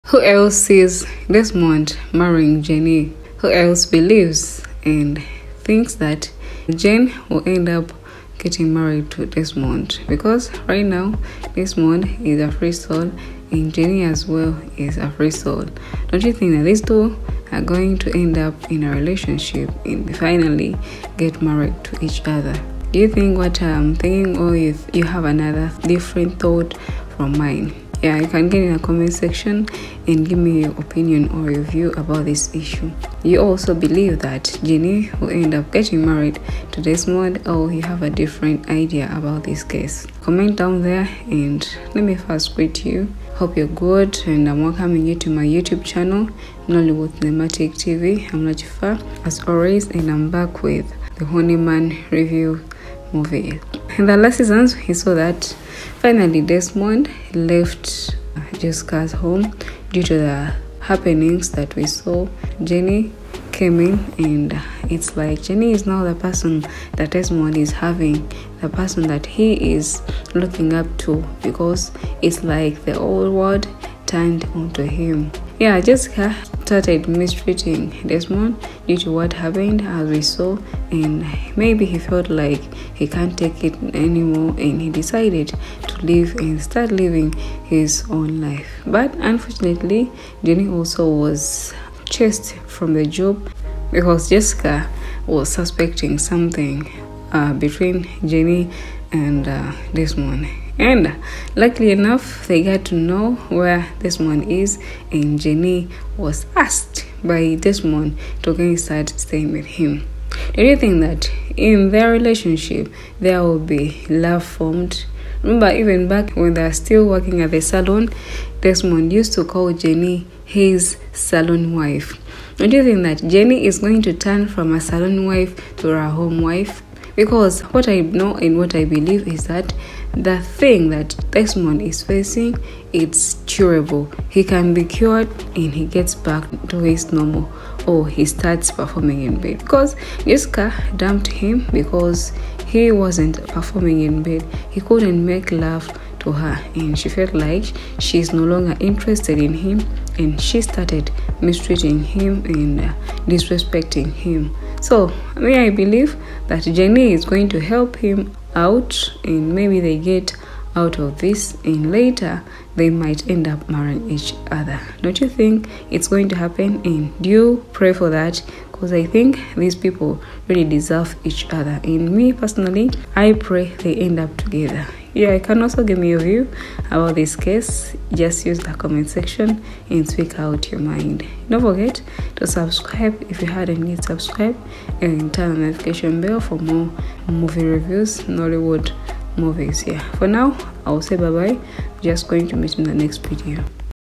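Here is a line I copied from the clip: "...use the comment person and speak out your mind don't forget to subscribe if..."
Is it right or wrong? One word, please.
wrong.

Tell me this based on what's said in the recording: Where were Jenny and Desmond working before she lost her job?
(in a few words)
the salon.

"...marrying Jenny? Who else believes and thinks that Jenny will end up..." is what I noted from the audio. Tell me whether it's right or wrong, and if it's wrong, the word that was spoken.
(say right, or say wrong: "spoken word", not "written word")
wrong: "Jane", not "Jenny".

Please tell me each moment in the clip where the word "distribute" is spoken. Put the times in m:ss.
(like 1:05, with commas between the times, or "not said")
not said.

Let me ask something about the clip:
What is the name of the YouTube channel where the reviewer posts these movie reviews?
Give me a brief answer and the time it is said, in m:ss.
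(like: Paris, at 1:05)
Nollywood Cinematic TV, at 0:46.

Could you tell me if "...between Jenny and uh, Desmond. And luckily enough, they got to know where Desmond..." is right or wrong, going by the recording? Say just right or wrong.
right.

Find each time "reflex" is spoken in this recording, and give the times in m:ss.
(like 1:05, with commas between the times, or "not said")
not said.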